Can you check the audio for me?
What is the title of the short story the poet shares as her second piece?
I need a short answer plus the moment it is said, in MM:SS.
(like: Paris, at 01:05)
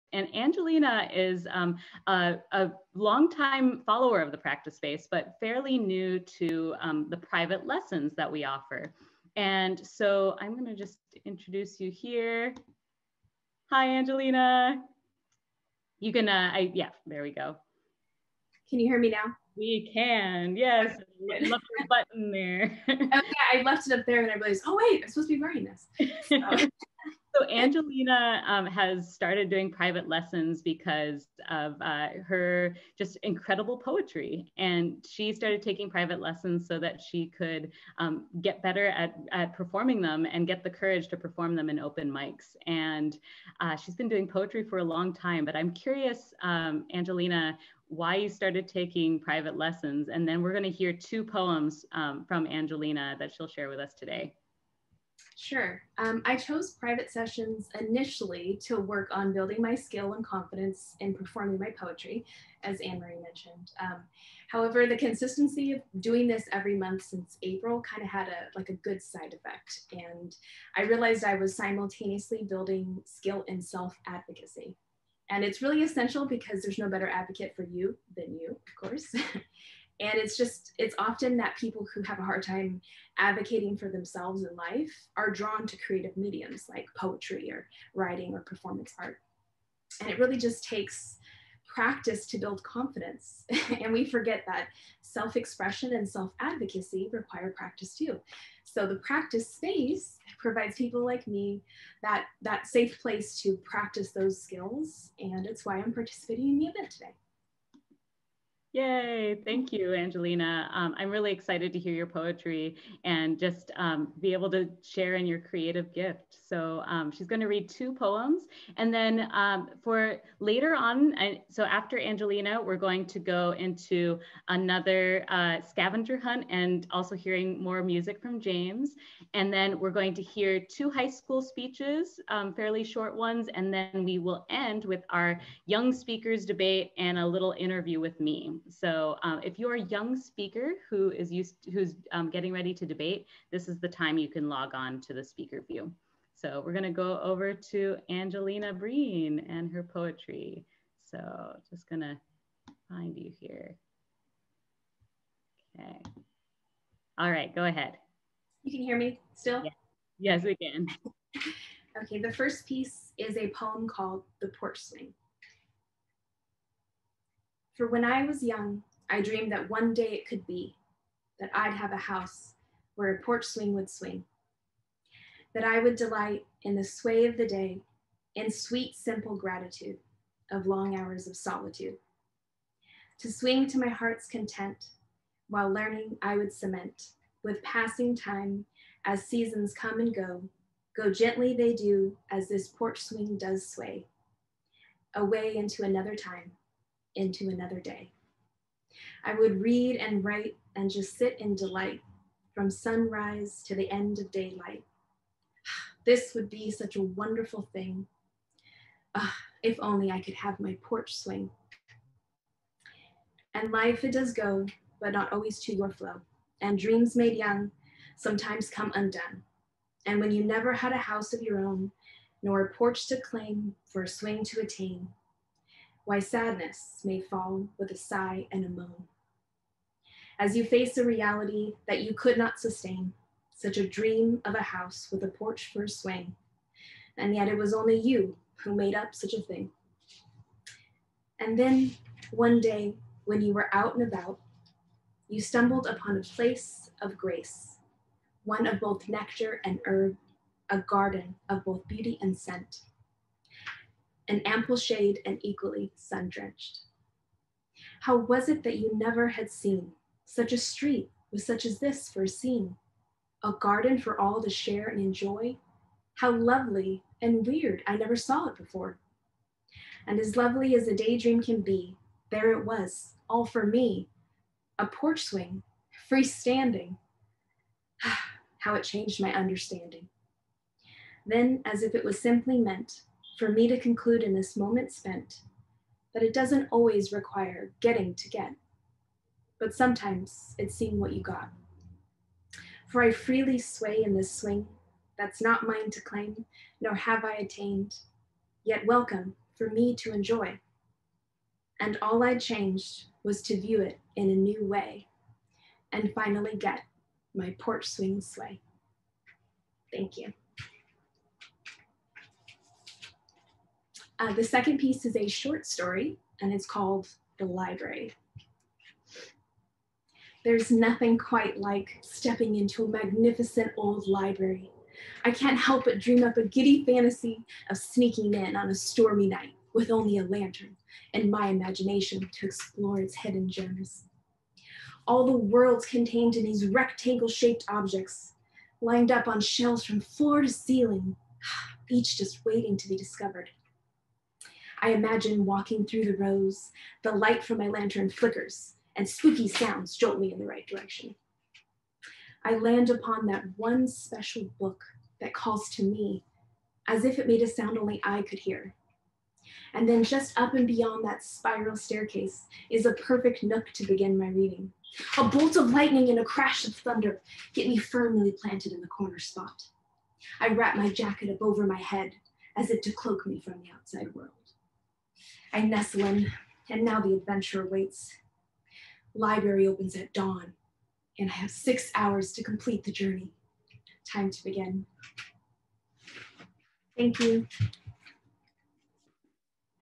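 The Library, at 05:17.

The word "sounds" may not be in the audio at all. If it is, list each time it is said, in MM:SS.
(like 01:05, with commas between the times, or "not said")
05:49, 05:57.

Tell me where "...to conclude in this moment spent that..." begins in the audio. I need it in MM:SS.
04:43.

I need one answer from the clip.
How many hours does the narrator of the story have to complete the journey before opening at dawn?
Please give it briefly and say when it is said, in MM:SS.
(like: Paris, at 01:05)
6, at 06:21.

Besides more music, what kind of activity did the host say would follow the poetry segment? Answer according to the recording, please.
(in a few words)
scavenger hunt.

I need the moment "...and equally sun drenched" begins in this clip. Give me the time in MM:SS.
04:15.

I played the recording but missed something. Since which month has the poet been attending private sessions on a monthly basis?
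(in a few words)
April.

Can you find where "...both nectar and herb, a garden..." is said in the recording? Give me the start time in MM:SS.
04:08.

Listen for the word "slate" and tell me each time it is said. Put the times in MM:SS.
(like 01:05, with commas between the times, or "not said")
not said.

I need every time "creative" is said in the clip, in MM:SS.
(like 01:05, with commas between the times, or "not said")
01:25, 01:55.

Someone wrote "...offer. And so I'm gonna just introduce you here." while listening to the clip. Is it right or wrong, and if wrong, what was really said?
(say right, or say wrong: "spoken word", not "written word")
right.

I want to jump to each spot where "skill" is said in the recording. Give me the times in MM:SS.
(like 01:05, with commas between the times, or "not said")
00:59, 01:13, 01:44.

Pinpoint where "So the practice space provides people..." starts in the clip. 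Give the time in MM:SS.
01:38.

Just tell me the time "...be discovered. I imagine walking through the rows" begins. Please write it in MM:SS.
05:42.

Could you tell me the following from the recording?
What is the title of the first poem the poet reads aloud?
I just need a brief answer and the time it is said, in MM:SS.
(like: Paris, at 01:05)
The Porch Swing, at 02:44.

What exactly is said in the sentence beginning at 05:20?
There's nothing quite like stepping into a magnificent old library.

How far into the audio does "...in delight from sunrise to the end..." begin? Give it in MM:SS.
03:21.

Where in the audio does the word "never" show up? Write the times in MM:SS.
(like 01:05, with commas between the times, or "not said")
03:40, 04:18, 04:27.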